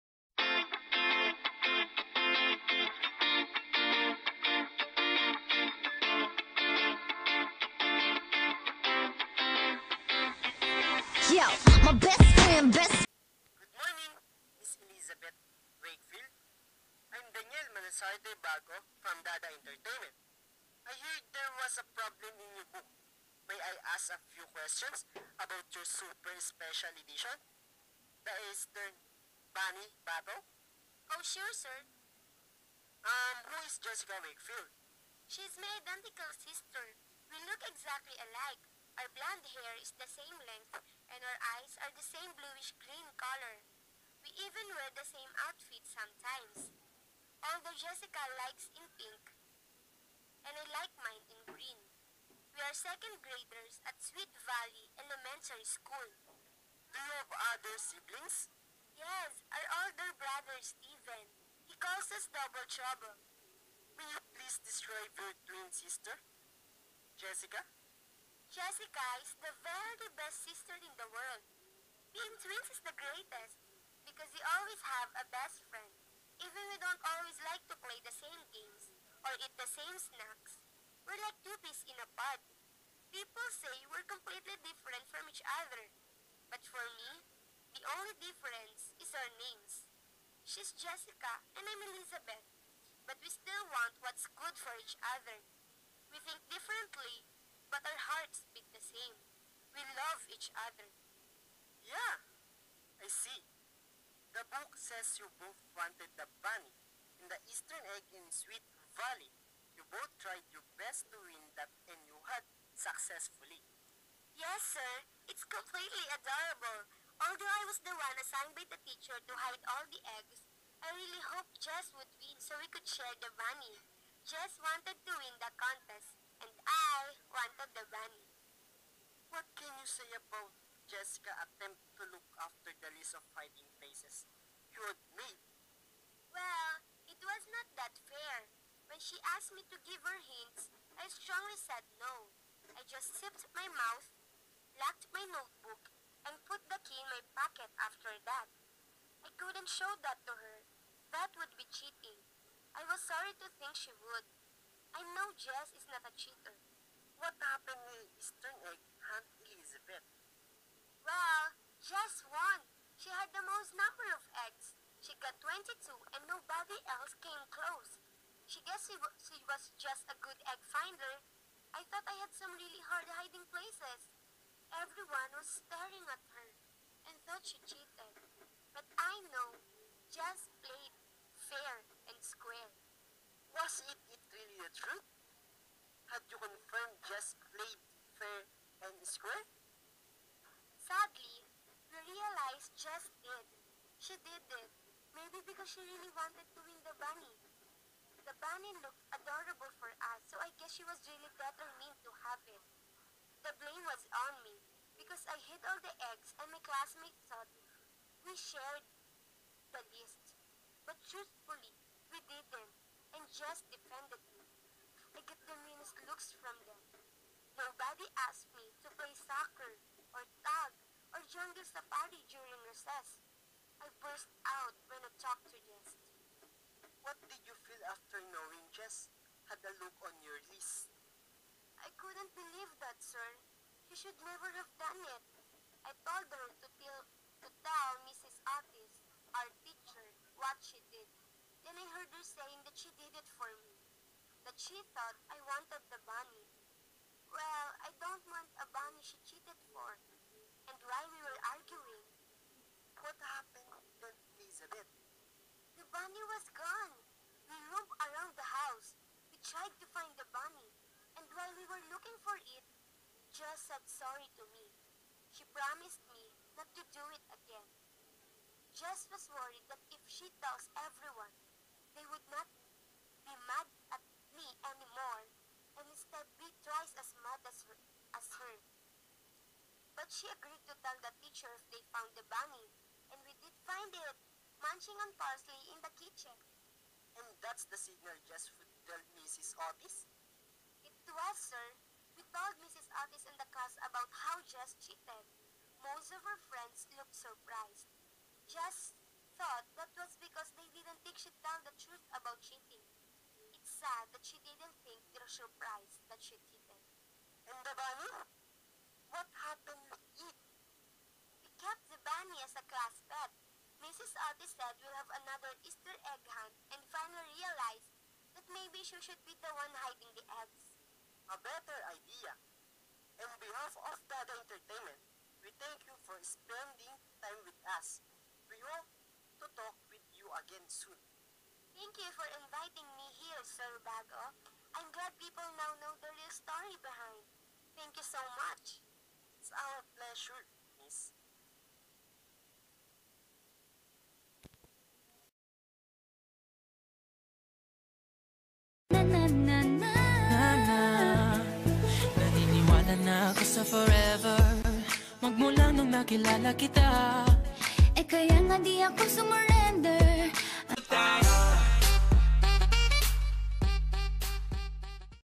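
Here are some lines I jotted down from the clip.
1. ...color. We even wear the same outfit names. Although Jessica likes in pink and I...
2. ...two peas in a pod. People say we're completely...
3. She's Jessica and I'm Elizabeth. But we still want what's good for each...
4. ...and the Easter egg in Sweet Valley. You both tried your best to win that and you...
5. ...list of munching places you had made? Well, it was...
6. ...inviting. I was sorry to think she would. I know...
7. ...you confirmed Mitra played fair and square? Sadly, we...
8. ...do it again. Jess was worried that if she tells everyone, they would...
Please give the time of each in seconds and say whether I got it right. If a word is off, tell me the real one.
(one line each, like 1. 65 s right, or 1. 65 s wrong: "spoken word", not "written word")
1. 43 s wrong: "sometimes", not "names"
2. 81 s right
3. 90 s right
4. 107 s right
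5. 132 s wrong: "hiding", not "munching"
6. 151 s wrong: "cheating", not "inviting"
7. 186 s wrong: "Jess", not "Mitra"
8. 266 s right.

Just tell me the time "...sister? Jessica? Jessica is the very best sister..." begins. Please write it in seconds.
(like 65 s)
65 s.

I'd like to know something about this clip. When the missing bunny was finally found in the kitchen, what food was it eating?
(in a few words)
parsley.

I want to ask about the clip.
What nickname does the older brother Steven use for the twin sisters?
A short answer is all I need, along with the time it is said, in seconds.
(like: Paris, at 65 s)
Double Trouble, at 62 s.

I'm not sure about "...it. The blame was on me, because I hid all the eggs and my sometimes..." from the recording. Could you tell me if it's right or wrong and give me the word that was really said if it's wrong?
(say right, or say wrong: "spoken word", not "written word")
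wrong: "classmates", not "sometimes".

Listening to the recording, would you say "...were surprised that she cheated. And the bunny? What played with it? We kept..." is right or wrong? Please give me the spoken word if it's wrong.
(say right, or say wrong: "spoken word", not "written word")
wrong: "happened", not "played".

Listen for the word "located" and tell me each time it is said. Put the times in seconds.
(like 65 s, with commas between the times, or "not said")
not said.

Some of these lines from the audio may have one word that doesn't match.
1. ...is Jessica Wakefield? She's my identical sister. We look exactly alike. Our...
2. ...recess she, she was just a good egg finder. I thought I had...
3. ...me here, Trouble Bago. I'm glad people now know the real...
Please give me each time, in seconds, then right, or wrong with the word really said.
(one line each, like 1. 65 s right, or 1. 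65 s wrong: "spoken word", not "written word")
1. 33 s right
2. 168 s wrong: "guess", not "recess"
3. 332 s wrong: "Sir", not "Trouble".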